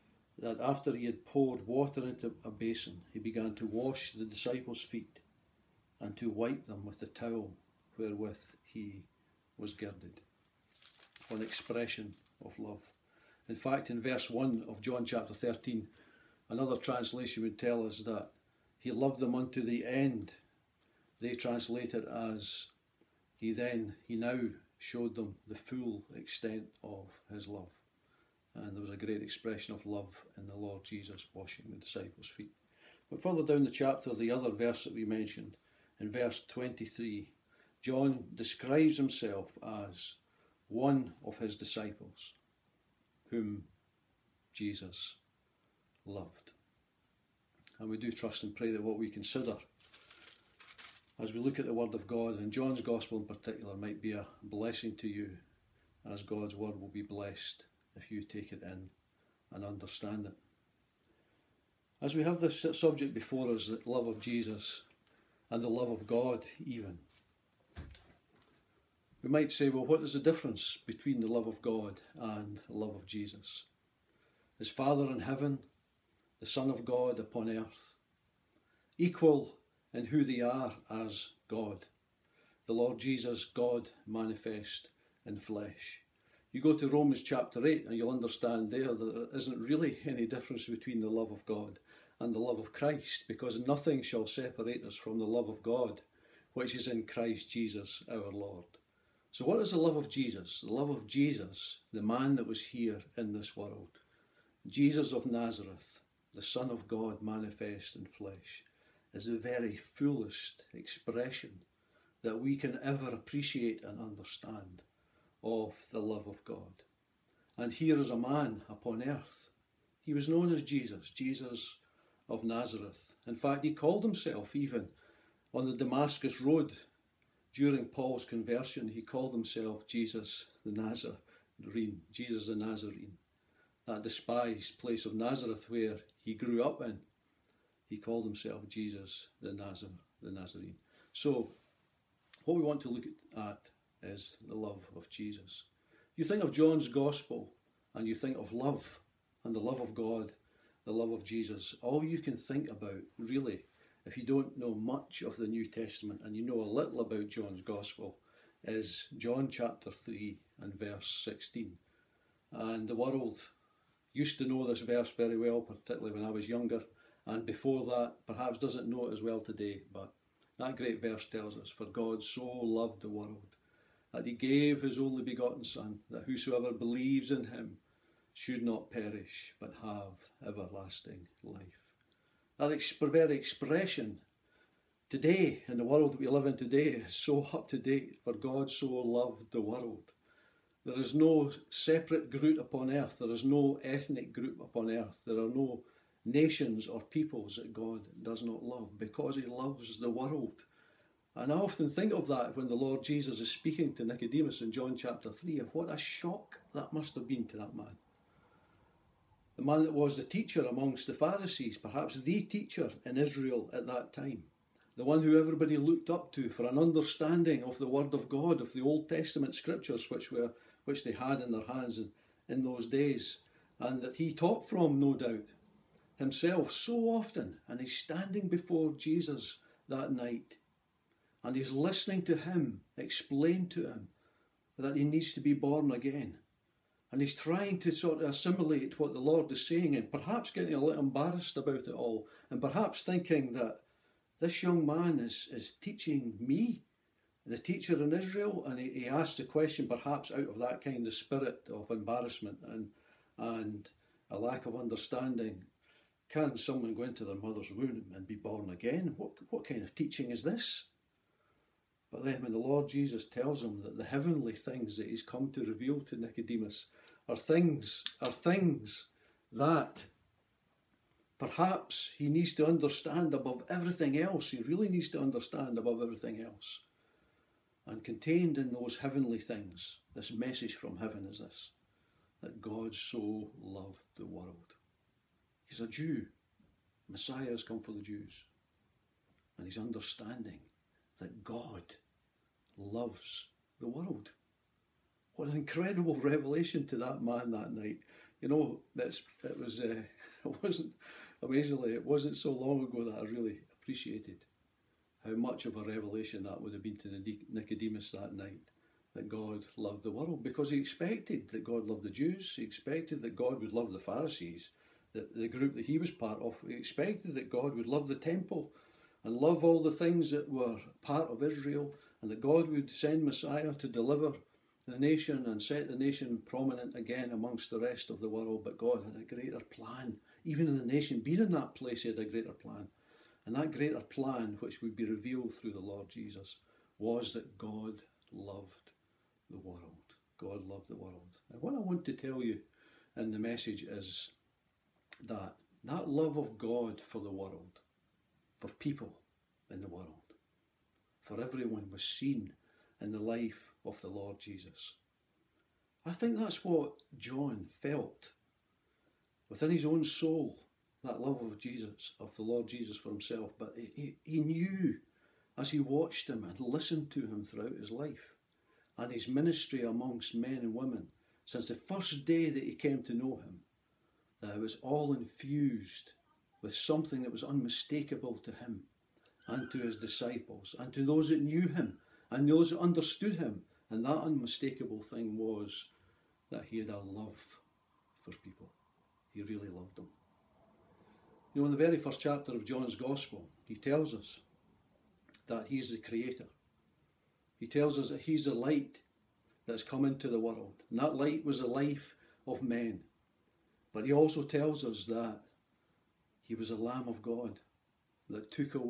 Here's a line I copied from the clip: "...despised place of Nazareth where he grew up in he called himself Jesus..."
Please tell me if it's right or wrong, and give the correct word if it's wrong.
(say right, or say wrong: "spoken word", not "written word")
right.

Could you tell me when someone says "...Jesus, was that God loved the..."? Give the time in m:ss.
5:36.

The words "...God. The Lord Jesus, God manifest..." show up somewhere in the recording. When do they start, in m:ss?
1:21.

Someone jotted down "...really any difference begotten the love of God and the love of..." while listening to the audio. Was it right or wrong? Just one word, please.
wrong.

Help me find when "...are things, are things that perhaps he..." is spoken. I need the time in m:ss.
4:27.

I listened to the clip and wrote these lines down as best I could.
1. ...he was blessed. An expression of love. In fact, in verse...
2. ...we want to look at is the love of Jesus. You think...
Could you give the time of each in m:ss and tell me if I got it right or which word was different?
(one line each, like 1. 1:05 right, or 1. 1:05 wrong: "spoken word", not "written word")
1. 0:08 wrong: "girded", not "blessed"
2. 2:22 right.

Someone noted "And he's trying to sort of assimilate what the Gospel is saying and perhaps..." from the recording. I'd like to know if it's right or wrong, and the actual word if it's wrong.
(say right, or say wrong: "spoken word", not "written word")
wrong: "Lord", not "Gospel".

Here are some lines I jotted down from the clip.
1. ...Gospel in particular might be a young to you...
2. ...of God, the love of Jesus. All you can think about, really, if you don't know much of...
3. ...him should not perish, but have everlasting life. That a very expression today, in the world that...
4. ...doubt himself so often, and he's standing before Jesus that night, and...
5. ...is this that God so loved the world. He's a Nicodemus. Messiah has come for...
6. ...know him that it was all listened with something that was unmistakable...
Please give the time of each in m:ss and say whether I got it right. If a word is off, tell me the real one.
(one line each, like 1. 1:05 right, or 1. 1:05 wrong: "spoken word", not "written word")
1. 0:52 wrong: "blessing", not "young"
2. 2:29 right
3. 2:57 right
4. 3:45 right
5. 4:41 wrong: "Jew", not "Nicodemus"
6. 6:13 wrong: "infused", not "listened".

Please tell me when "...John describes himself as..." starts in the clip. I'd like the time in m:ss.
0:37.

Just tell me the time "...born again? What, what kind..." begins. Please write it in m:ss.
4:18.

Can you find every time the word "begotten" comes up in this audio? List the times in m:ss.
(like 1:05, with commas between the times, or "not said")
2:55.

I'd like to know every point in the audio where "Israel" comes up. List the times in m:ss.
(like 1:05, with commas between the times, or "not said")
3:33, 4:08, 5:21.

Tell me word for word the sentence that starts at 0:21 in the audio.
They translate it as he then, he now showed them the full extent of his love.